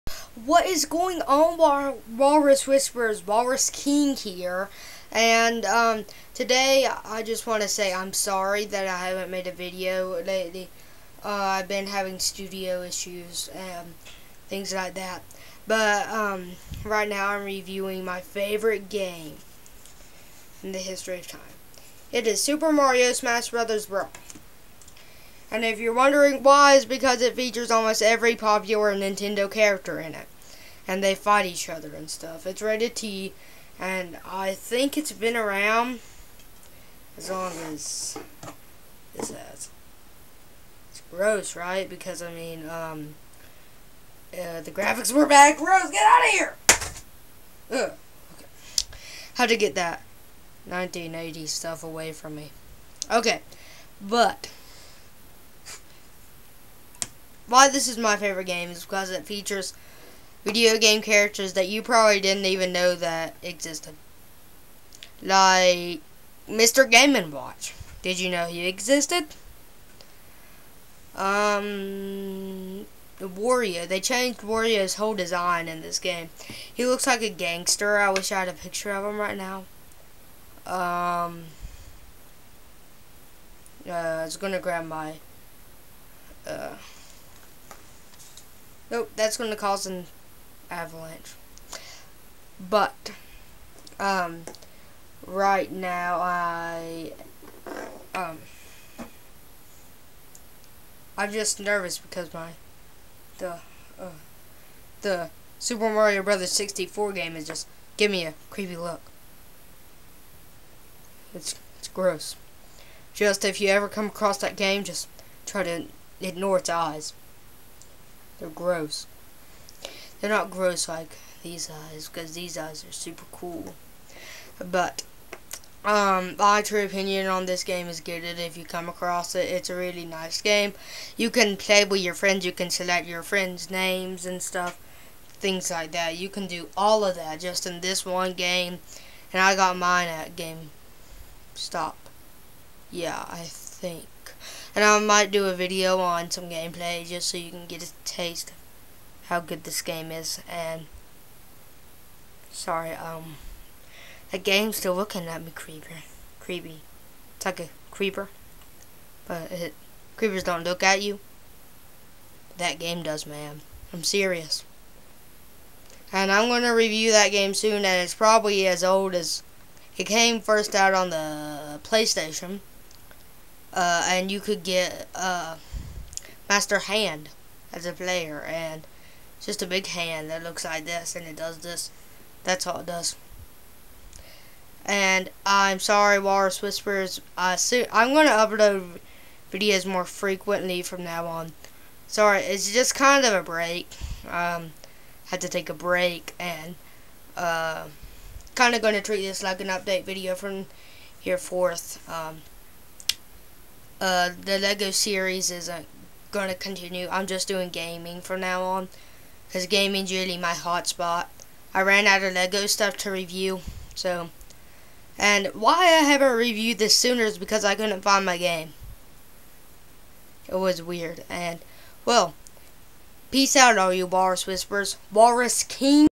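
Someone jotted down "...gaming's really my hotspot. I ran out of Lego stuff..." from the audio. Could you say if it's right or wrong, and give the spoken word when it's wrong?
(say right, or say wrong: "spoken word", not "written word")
right.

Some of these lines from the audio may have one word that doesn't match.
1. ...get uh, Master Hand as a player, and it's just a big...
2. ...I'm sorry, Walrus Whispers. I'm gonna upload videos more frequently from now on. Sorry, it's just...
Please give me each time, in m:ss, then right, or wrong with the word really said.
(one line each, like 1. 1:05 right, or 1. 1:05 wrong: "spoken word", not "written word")
1. 2:54 right
2. 3:05 right.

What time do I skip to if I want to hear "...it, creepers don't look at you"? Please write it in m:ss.
2:39.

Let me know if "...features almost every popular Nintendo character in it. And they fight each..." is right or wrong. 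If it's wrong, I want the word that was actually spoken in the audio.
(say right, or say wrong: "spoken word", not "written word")
right.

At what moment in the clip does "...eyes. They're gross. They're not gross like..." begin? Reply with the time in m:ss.
1:56.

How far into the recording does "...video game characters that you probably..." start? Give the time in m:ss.
1:00.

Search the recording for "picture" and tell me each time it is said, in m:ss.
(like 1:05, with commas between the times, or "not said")
1:18.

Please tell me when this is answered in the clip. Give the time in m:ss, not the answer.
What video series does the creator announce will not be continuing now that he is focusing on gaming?
3:24.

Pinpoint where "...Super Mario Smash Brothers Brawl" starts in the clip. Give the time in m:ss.
0:22.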